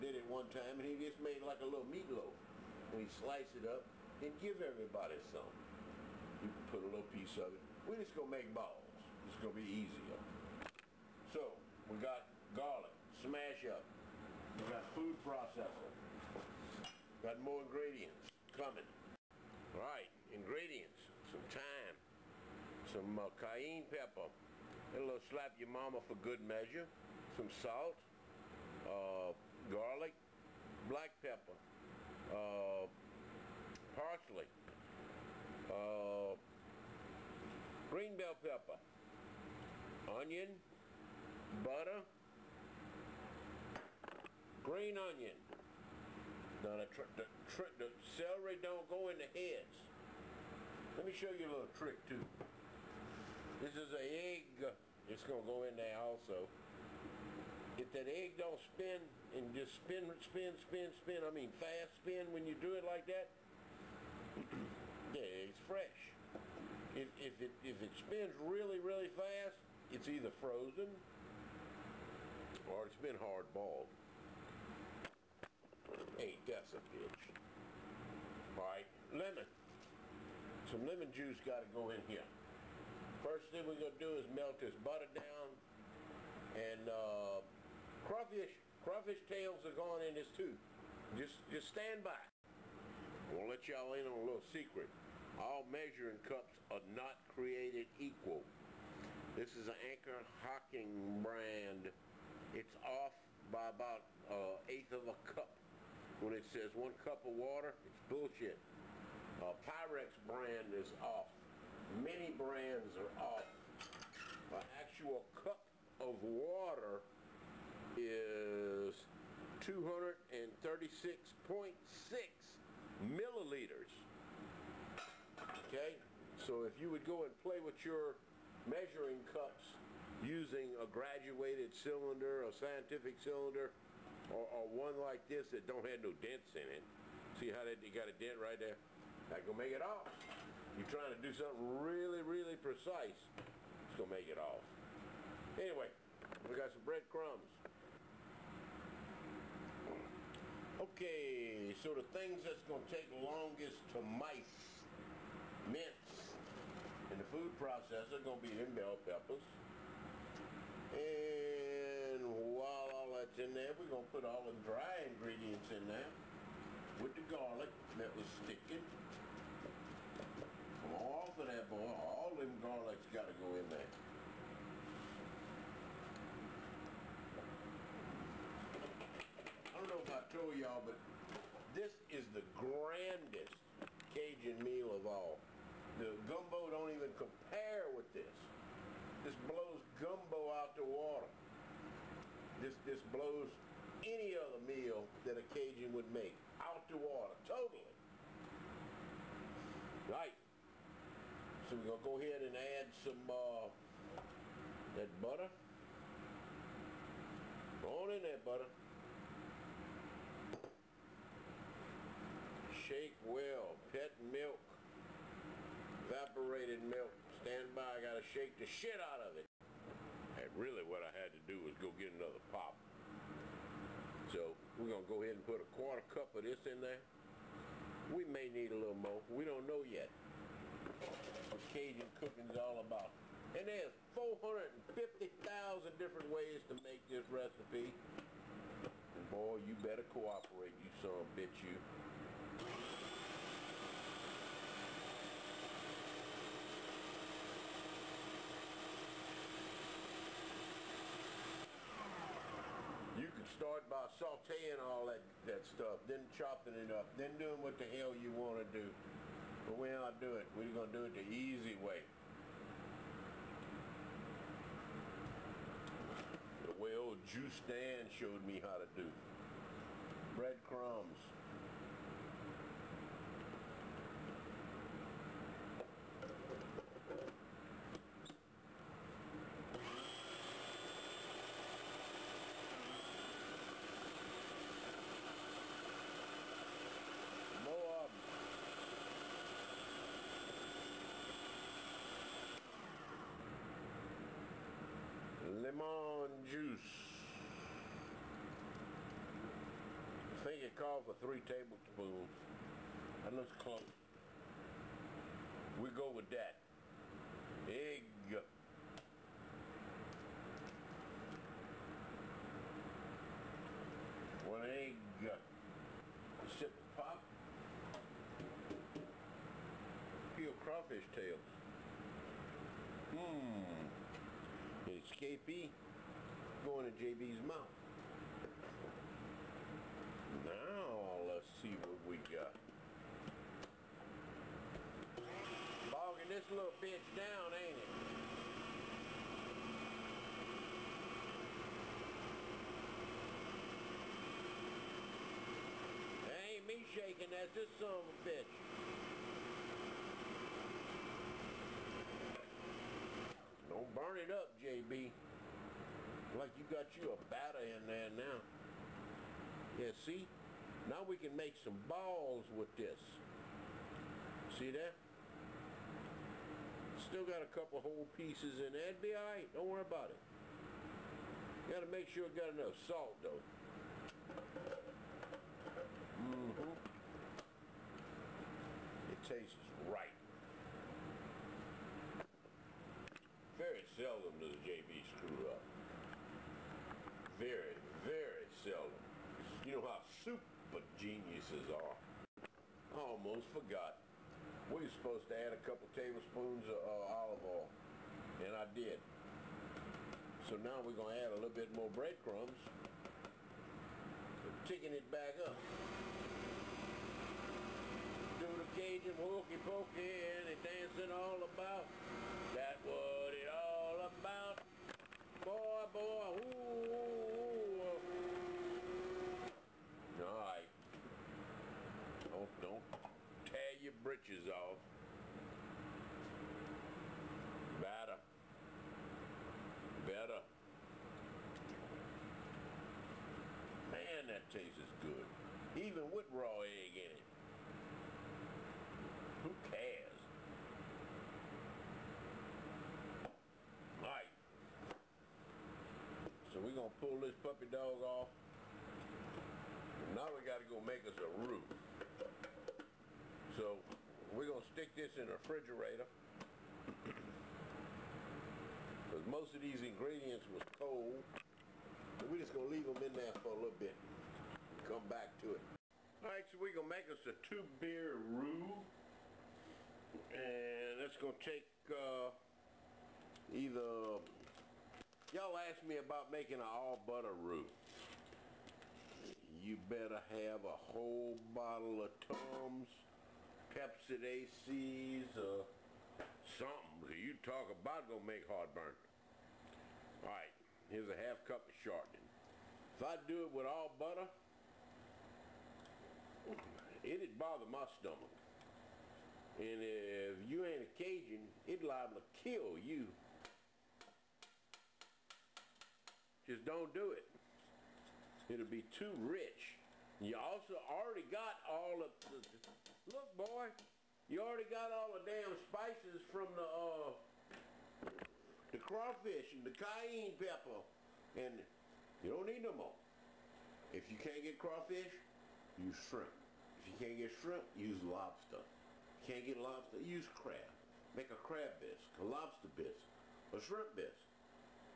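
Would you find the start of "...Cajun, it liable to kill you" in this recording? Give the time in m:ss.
8:20.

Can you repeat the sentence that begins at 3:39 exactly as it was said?
And really what I had to do was go get another pop.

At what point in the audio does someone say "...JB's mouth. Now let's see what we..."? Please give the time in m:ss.
5:27.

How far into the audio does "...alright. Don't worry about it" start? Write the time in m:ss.
6:09.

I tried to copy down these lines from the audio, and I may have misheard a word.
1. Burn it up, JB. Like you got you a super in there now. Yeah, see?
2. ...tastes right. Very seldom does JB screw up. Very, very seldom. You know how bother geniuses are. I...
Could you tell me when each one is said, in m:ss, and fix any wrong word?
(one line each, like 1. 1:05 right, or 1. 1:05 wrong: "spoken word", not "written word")
1. 5:53 wrong: "batter", not "super"
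2. 6:19 wrong: "super", not "bother".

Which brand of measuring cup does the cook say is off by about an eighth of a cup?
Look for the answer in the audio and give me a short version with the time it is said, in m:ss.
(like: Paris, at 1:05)
Anchor Hocking, at 1:39.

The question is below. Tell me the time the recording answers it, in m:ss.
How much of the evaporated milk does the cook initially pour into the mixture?
3:45.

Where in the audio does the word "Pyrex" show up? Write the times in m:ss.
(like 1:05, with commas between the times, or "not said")
1:49.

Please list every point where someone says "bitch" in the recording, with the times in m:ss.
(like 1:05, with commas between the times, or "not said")
1:16, 4:01, 5:36, 5:48.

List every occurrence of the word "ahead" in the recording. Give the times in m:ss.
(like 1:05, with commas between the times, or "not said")
3:22, 3:45.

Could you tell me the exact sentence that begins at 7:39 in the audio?
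Because most of these ingredients was cold.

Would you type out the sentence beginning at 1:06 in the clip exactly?
If, if, it, if it spins really, really fast, it's either frozen or it's been hard boiled.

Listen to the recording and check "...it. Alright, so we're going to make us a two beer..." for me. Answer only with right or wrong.
right.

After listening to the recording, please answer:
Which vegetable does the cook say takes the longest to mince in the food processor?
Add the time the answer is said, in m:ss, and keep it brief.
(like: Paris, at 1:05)
bell peppers, at 2:38.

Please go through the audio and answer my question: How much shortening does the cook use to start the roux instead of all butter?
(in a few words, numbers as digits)
a half cup.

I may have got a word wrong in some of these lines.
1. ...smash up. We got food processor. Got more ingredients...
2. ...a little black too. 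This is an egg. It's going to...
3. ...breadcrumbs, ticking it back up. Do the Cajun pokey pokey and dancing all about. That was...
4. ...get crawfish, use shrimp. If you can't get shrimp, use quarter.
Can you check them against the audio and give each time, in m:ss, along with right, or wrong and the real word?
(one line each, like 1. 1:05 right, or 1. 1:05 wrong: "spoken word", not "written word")
1. 0:13 right
2. 0:51 wrong: "trick", not "black"
3. 6:41 wrong: "hokey", not "pokey"
4. 8:44 wrong: "lobster", not "quarter".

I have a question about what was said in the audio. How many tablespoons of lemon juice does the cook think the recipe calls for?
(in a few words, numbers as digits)
3.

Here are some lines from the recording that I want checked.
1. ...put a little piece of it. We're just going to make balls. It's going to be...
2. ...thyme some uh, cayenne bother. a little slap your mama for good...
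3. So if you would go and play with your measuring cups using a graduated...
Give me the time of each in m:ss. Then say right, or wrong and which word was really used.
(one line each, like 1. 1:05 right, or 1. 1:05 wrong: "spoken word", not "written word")
1. 0:06 right
2. 0:21 wrong: "pepper", not "bother"
3. 2:06 right.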